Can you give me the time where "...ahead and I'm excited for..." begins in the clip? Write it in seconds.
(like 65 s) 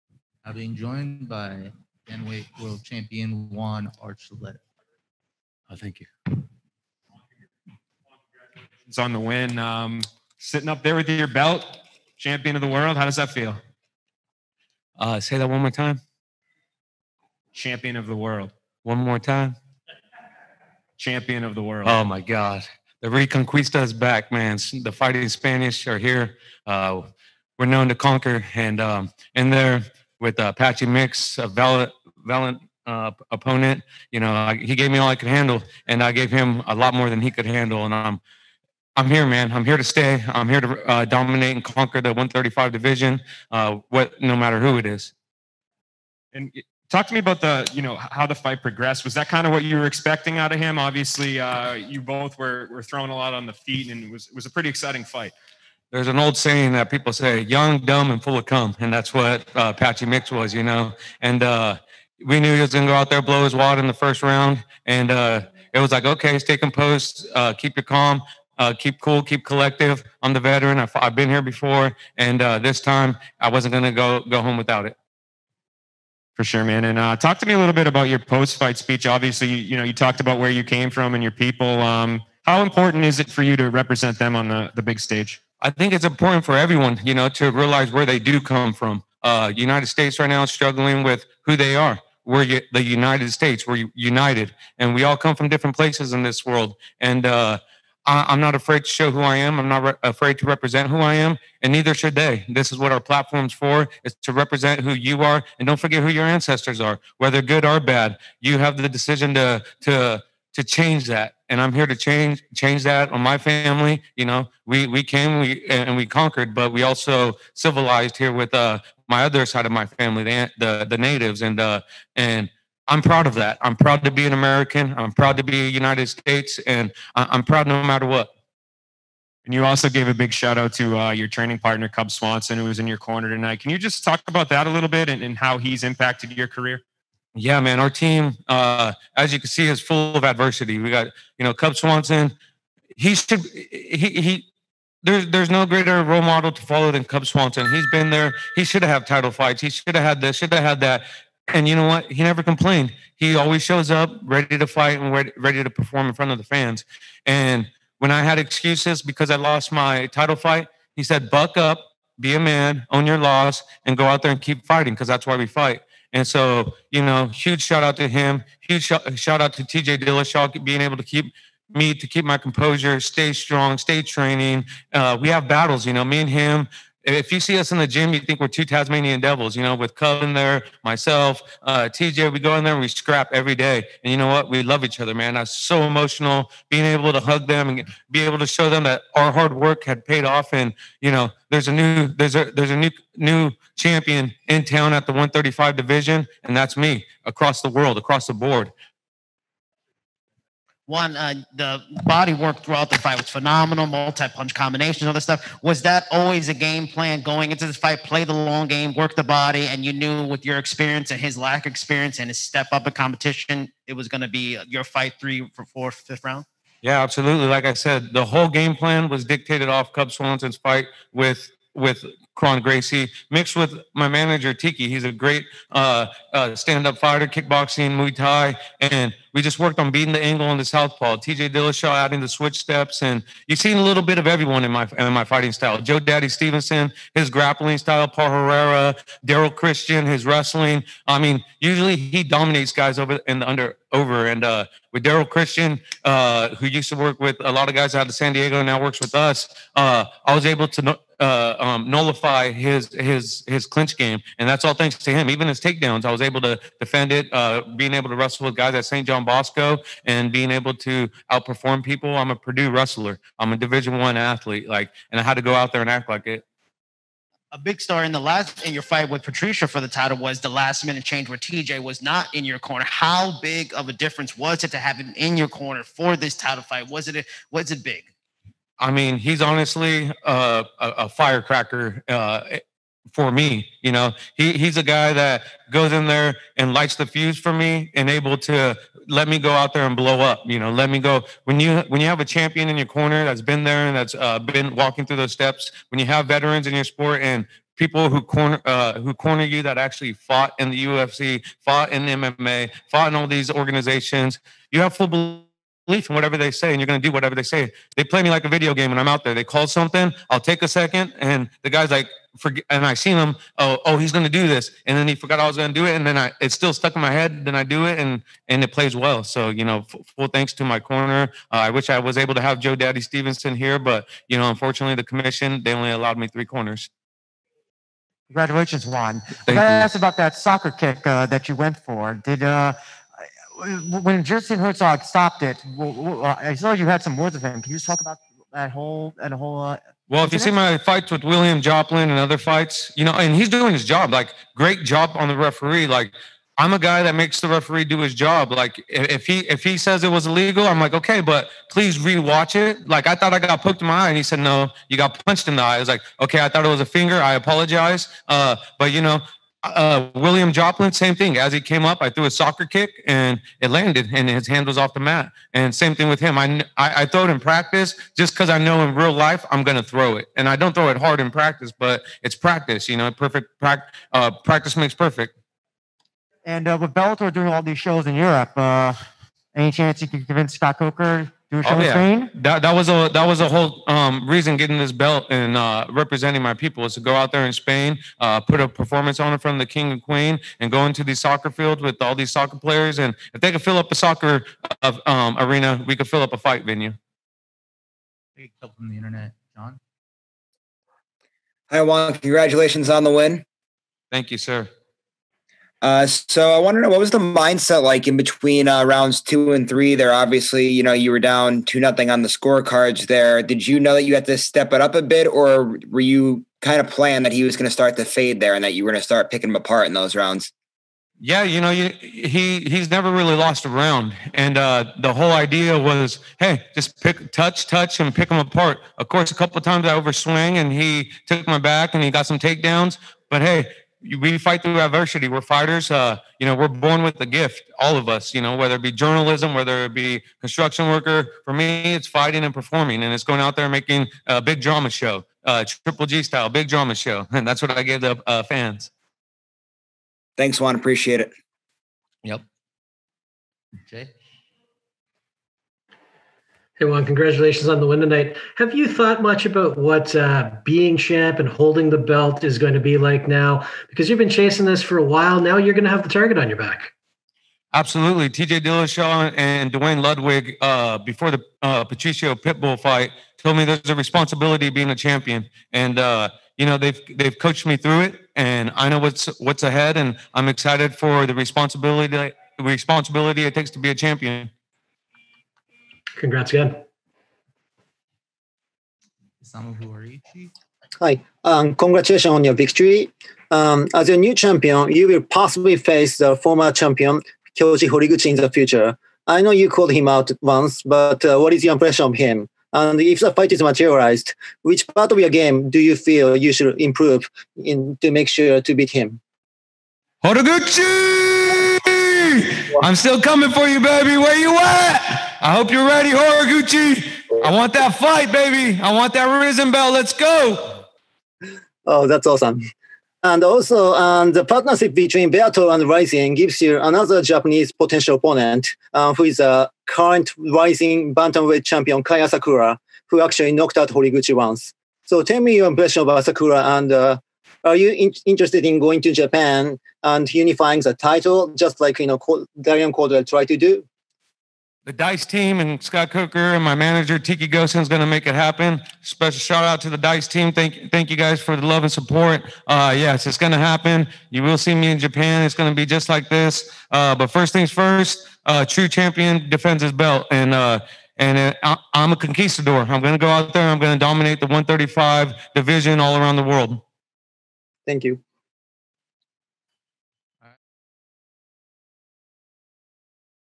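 479 s.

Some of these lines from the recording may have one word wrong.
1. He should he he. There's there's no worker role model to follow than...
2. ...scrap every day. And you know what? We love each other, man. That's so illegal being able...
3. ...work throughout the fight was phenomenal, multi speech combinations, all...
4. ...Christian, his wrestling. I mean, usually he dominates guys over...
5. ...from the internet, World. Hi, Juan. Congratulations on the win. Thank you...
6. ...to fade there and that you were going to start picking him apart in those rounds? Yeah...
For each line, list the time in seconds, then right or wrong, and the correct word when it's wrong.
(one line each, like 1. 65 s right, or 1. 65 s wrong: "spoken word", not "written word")
1. 142 s wrong: "greater", not "worker"
2. 182 s wrong: "emotional", not "illegal"
3. 202 s wrong: "punch", not "speech"
4. 239 s right
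5. 398 s wrong: "John", not "World"
6. 417 s right.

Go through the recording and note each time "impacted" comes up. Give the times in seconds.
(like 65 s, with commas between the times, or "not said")
135 s.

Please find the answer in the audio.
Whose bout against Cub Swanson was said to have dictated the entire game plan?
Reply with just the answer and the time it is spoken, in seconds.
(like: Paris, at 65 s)
Kron Gracie, at 222 s.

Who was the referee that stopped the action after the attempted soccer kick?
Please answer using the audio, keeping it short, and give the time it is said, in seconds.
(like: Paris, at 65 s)
Jason Herzog, at 334 s.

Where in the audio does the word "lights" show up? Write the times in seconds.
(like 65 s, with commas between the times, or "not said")
286 s.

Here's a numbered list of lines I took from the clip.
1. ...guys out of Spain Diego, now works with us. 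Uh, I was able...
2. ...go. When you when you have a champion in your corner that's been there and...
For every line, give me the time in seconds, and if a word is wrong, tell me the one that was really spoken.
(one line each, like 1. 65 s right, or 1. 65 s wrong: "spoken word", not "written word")
1. 247 s wrong: "San", not "Spain"
2. 290 s right.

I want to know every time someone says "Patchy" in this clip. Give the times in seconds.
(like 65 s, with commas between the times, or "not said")
30 s, 59 s.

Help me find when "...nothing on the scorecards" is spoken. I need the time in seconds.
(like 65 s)
411 s.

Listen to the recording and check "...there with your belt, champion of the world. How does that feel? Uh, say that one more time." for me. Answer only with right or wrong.
right.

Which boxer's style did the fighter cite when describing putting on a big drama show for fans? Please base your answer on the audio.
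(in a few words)
Triple G.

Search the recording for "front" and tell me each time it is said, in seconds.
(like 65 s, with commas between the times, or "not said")
156 s, 389 s.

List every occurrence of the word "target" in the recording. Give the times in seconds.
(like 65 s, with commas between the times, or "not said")
466 s.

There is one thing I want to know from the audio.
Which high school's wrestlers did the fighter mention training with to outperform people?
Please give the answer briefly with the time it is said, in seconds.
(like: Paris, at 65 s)
St. John Bosco, at 258 s.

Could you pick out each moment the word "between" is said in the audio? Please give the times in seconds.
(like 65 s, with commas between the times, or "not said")
408 s, 524 s.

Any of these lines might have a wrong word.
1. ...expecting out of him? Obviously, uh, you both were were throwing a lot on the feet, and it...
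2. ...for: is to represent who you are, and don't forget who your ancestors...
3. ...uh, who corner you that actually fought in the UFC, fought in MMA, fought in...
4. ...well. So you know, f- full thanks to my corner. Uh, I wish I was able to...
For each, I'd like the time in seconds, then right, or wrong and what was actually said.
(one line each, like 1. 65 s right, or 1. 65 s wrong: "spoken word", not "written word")
1. 49 s right
2. 103 s right
3. 298 s right
4. 318 s right.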